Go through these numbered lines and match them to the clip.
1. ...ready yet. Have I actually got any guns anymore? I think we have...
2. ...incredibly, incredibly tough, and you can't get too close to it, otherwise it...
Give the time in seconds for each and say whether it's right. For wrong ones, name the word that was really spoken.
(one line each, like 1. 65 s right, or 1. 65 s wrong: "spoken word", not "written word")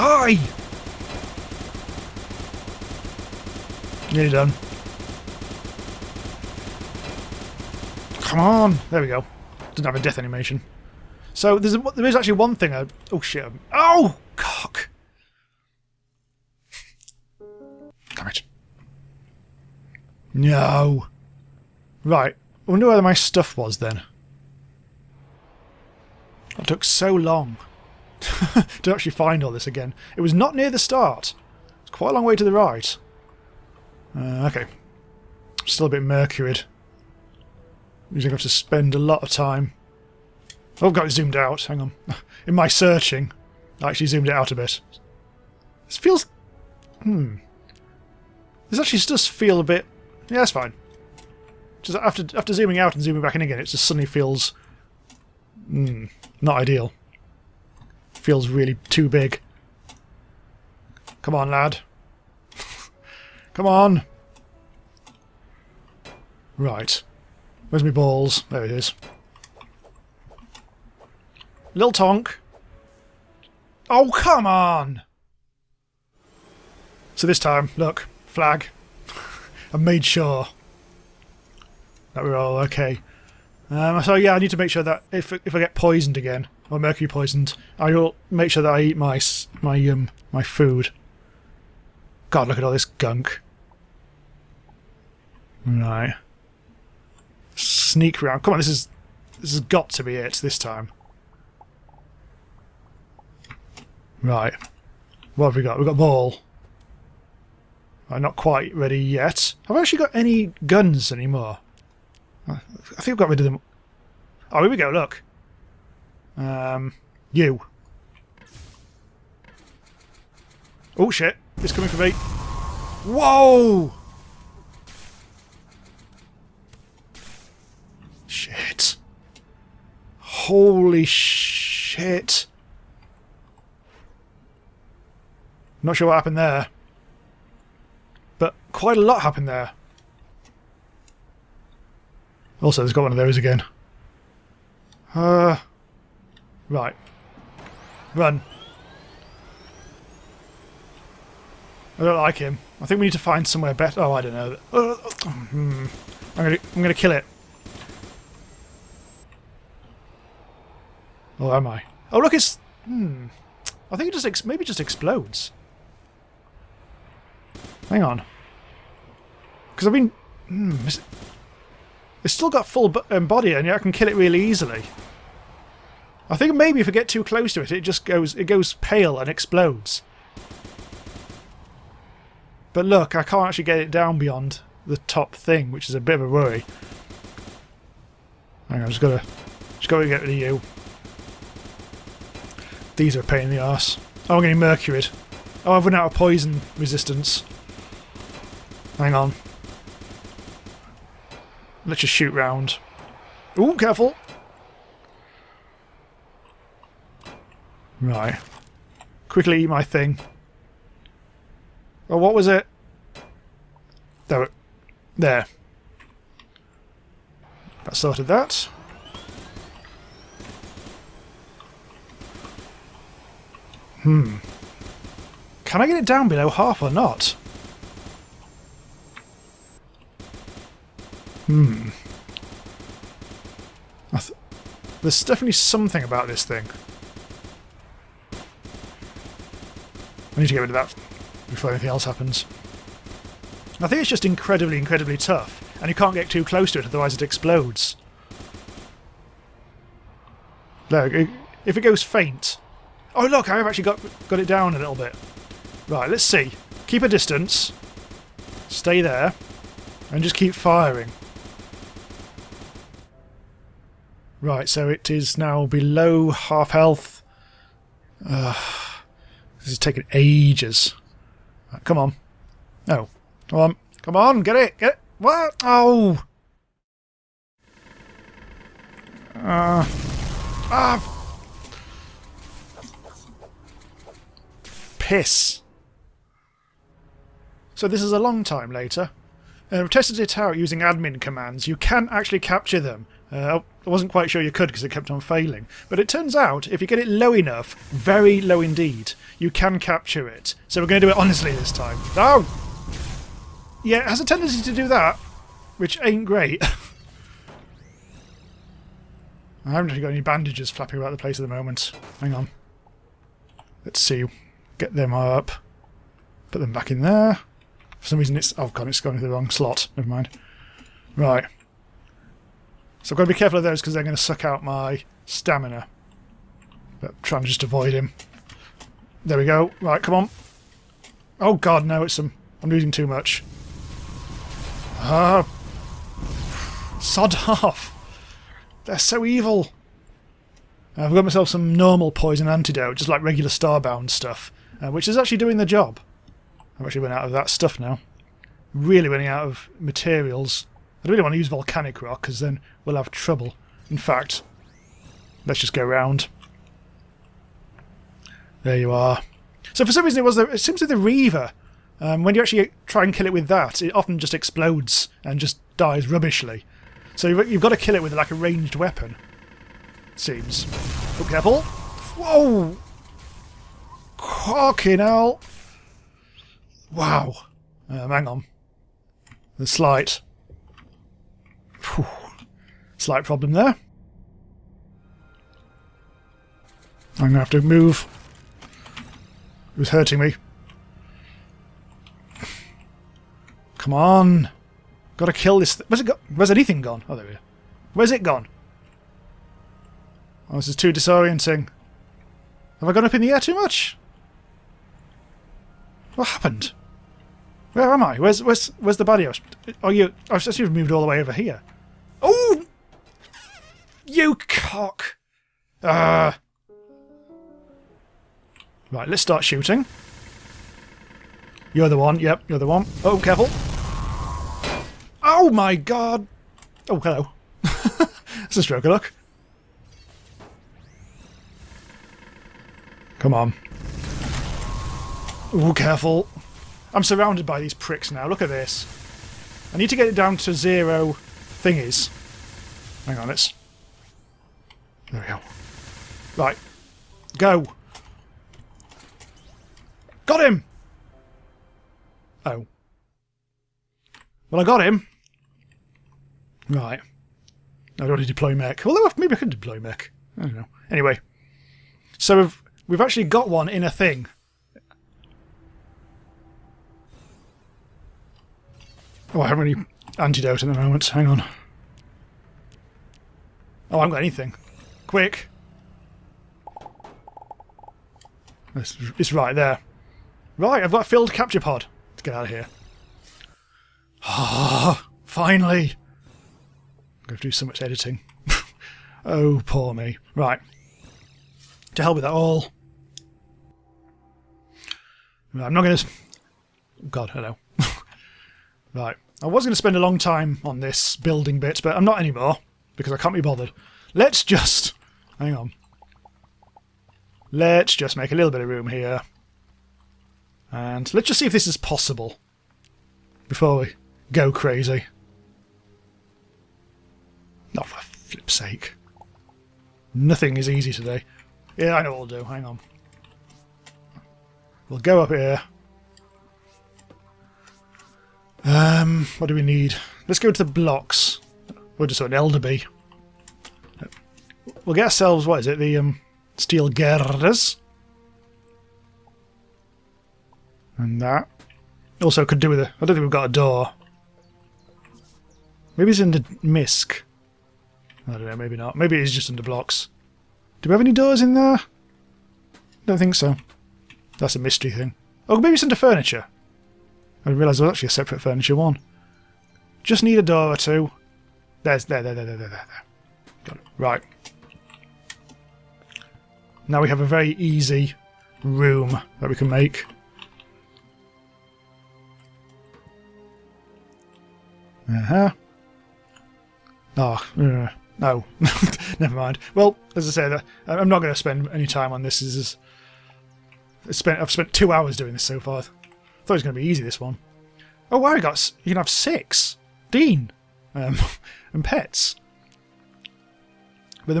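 1. 108 s right
2. 244 s right.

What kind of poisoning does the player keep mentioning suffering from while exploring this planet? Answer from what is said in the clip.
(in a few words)
mercury.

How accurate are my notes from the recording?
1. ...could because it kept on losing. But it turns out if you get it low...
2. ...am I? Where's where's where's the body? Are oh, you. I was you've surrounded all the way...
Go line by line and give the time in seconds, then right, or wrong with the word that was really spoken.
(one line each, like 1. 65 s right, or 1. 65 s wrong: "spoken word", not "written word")
1. 294 s wrong: "failing", not "losing"
2. 407 s wrong: "moved", not "surrounded".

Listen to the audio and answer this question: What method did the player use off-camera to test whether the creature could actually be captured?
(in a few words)
admin commands.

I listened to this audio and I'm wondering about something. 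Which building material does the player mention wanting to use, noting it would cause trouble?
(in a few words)
volcanic rock.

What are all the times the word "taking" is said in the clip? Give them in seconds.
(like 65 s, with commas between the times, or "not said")
269 s.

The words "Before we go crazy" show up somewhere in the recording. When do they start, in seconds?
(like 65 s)
513 s.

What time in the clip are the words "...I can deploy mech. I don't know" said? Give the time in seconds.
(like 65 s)
459 s.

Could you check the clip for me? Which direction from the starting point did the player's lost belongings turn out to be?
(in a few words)
to the right.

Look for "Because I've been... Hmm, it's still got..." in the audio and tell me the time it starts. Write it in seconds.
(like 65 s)
169 s.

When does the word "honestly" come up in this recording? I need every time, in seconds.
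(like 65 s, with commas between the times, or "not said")
301 s.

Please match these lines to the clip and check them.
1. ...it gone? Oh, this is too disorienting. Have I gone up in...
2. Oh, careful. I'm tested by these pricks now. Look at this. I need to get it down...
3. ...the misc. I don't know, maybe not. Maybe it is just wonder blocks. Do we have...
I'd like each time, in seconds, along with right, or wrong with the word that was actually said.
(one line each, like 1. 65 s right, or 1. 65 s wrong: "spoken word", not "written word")
1. 398 s right
2. 435 s wrong: "surrounded", not "tested"
3. 546 s wrong: "under", not "wonder".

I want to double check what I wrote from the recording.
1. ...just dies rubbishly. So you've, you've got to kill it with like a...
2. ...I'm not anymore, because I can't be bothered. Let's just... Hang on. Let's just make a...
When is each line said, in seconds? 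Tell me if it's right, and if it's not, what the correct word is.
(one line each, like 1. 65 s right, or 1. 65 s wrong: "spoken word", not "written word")
1. 365 s right
2. 501 s right.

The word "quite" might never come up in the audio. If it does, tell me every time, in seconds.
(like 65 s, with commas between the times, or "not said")
31 s, 108 s, 138 s, 294 s.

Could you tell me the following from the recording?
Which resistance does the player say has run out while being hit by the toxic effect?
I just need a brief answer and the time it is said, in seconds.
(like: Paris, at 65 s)
poison resistance, at 196 s.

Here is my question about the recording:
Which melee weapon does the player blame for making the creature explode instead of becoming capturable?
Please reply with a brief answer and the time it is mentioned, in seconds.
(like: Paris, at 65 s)
the Reaver, at 360 s.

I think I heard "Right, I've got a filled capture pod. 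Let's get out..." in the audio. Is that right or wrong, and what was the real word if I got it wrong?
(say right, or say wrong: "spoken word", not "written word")
right.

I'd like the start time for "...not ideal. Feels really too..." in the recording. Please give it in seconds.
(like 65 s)
56 s.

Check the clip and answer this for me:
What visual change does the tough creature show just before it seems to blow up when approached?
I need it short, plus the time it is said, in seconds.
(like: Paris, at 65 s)
it goes pale, at 178 s.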